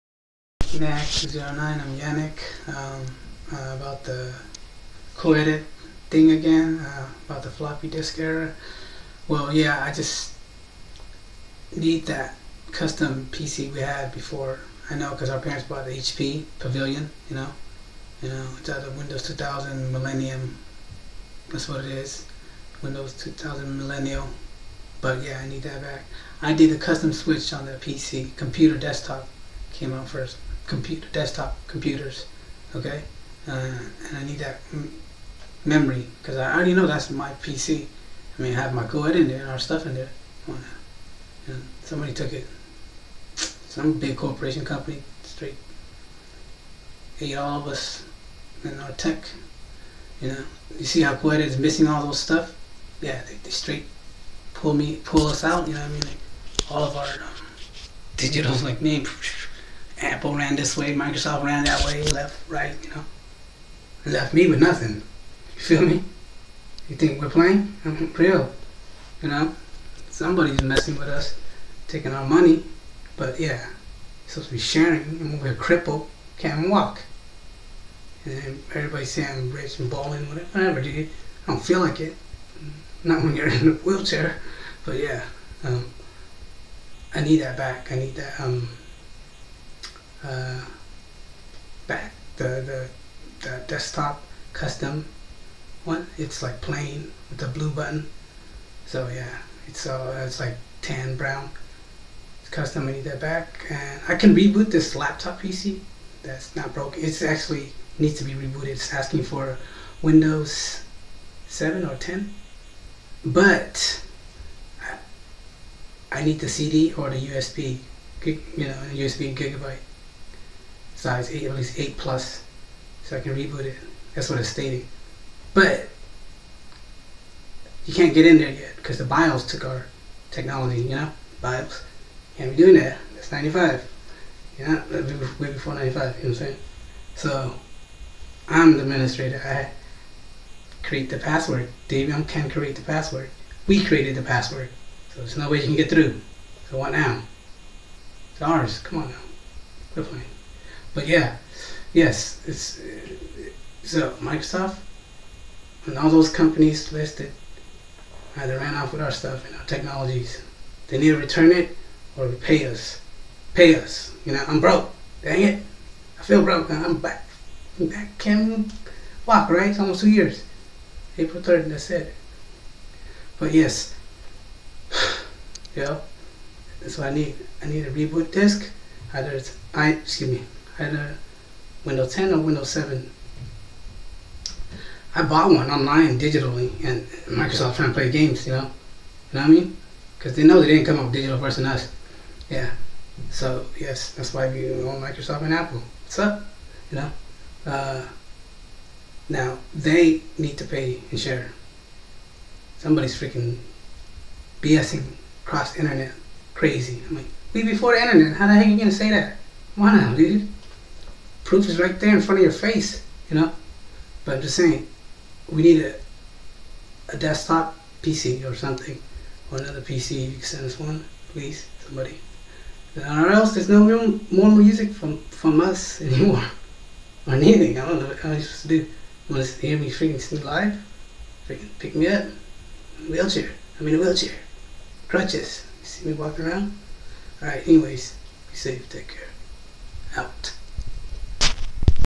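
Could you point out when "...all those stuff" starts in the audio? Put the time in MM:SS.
00:51.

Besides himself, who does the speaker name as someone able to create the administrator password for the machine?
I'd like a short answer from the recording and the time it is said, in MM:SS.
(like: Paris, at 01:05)
Davion, at 02:21.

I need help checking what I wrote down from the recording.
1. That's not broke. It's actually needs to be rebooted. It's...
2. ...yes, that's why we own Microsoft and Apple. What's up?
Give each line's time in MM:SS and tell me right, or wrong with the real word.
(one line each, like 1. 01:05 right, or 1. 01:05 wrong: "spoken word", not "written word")
1. 01:46 right
2. 03:13 right.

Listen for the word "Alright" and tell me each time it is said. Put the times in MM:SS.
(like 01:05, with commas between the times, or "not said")
03:57.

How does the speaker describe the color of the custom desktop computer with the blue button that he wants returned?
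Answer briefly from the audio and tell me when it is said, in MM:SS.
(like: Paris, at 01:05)
Tan brown, at 01:40.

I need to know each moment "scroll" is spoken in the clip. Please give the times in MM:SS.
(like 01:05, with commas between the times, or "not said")
not said.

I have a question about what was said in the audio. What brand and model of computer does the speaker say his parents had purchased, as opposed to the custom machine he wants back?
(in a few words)
HP Pavilion.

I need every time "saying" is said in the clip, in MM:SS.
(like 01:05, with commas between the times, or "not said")
01:19, 02:16, 03:34.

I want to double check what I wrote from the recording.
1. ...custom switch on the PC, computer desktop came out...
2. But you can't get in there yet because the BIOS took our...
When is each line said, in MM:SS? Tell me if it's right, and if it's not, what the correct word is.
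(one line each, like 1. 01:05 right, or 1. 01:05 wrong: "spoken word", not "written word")
1. 00:26 right
2. 02:05 right.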